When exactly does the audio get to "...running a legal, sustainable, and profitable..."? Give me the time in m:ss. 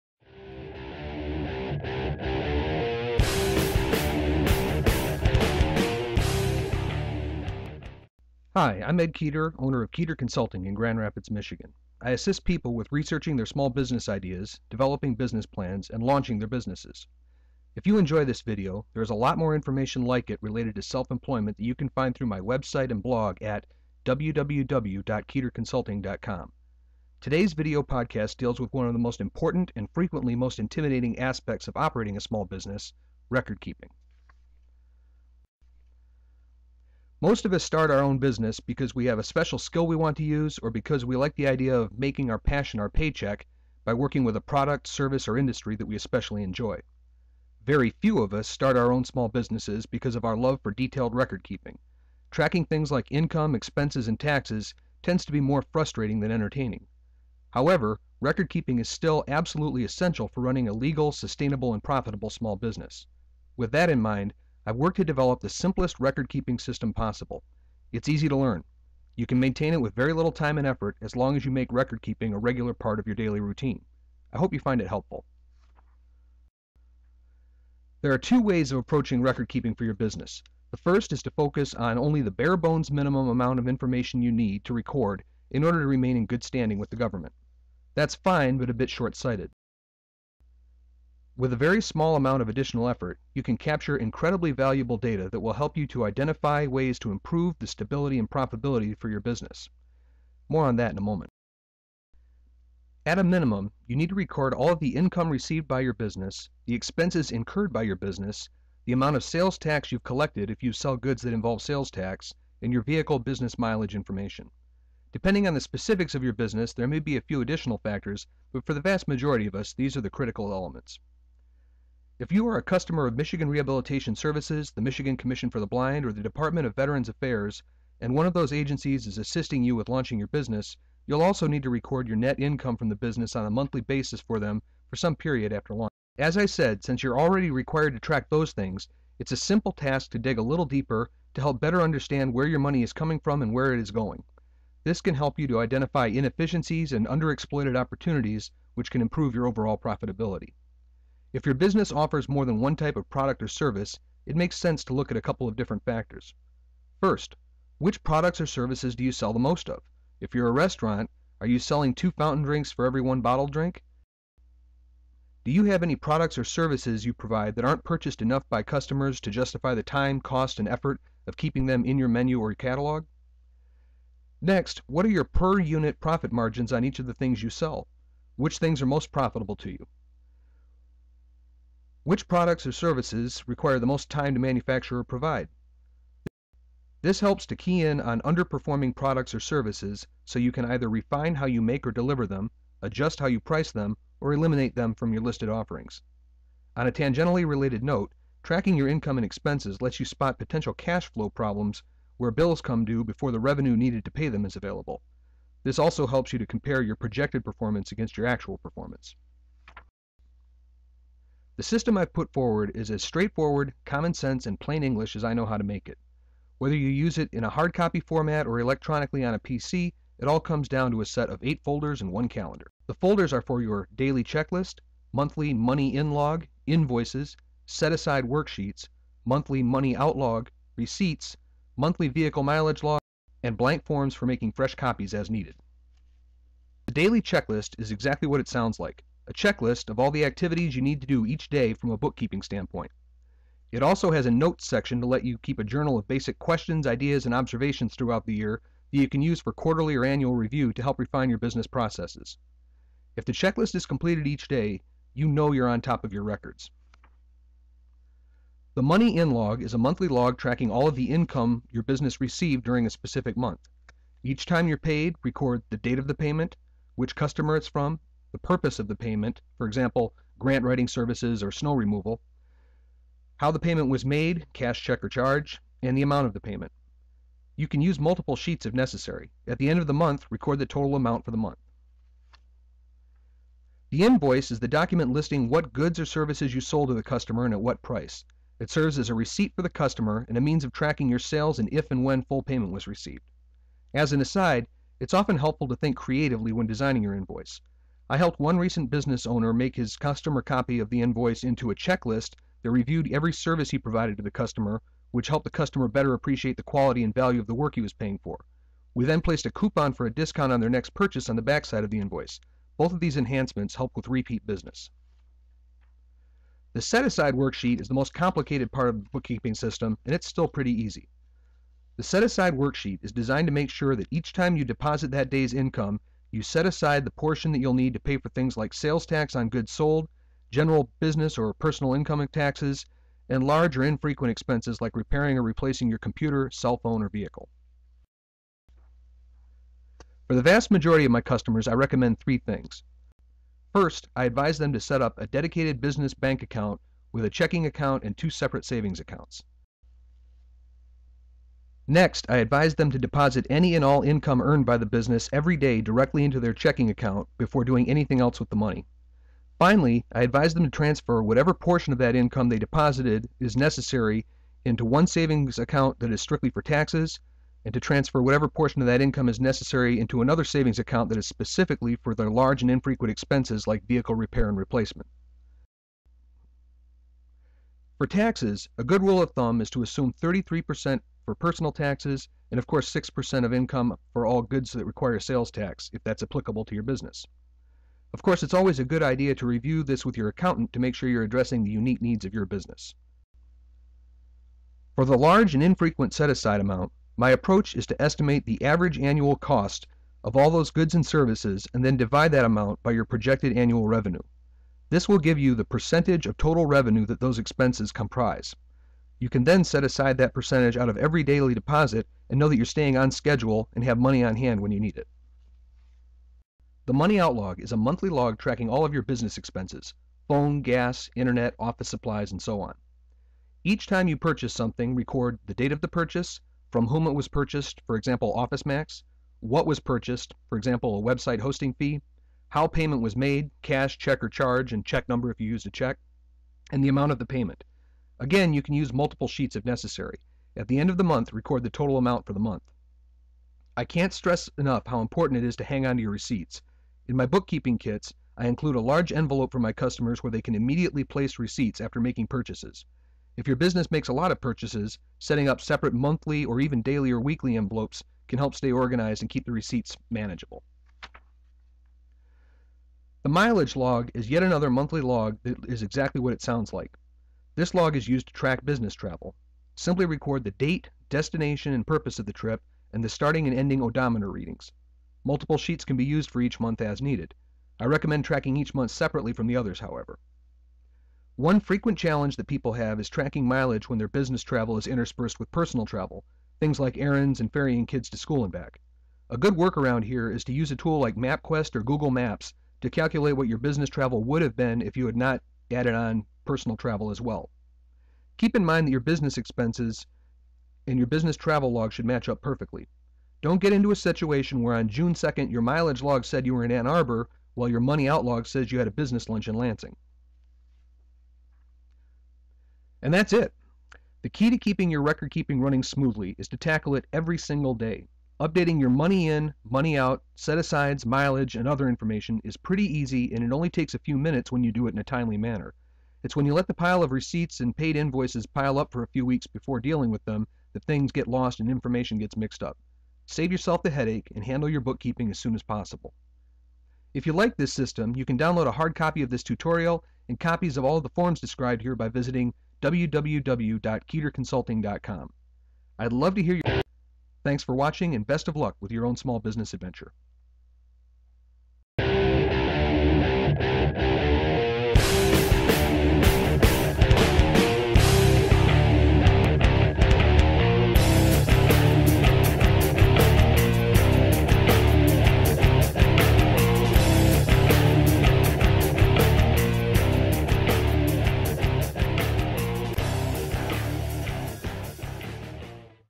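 1:00.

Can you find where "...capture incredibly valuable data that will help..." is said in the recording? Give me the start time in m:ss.
1:33.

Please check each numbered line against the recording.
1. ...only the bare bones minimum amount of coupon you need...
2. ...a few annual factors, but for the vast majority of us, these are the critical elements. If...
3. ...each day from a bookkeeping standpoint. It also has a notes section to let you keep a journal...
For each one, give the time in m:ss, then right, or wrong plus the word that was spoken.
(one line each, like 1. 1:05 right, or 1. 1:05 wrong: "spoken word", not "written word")
1. 1:21 wrong: "information", not "coupon"
2. 1:57 wrong: "additional", not "annual"
3. 4:01 right.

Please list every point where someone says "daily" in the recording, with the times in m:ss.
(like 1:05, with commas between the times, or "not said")
1:13, 3:43, 3:56, 6:51, 7:36.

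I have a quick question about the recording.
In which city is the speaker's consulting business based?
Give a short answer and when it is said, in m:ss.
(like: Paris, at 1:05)
Grand Rapids, at 0:10.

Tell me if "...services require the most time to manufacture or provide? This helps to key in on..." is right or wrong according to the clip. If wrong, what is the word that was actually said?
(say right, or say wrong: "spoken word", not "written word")
right.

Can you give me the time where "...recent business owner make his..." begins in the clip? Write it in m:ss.
4:58.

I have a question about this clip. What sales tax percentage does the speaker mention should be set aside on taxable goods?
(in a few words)
6%.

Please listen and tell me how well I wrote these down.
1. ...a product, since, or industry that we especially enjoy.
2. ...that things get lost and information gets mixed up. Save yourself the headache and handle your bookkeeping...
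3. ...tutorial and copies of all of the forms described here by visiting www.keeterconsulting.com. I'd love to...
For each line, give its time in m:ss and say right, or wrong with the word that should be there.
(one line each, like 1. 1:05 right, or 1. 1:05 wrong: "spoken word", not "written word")
1. 0:44 wrong: "service", not "since"
2. 8:50 right
3. 8:59 right.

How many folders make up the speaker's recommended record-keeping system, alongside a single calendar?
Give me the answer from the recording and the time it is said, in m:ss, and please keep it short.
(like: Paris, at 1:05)
8, at 3:41.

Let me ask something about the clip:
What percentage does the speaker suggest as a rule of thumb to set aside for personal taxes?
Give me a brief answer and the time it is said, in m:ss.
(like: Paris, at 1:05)
33%, at 6:20.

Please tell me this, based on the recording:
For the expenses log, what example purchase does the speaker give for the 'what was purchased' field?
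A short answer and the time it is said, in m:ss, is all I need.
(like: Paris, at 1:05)
Website hosting fee, at 7:11.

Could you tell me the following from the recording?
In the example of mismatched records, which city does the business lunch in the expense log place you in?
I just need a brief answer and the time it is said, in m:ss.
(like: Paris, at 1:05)
Lansing, at 8:29.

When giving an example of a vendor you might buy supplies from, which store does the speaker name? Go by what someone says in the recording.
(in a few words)
OfficeMax.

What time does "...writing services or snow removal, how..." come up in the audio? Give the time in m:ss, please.
4:30.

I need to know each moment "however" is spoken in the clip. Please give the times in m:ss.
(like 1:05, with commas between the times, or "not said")
0:57, 7:59.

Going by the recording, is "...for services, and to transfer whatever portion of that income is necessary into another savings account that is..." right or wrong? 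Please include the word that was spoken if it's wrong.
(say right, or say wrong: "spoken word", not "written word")
wrong: "taxes", not "services".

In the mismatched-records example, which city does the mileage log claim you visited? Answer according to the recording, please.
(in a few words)
Ann Arbor.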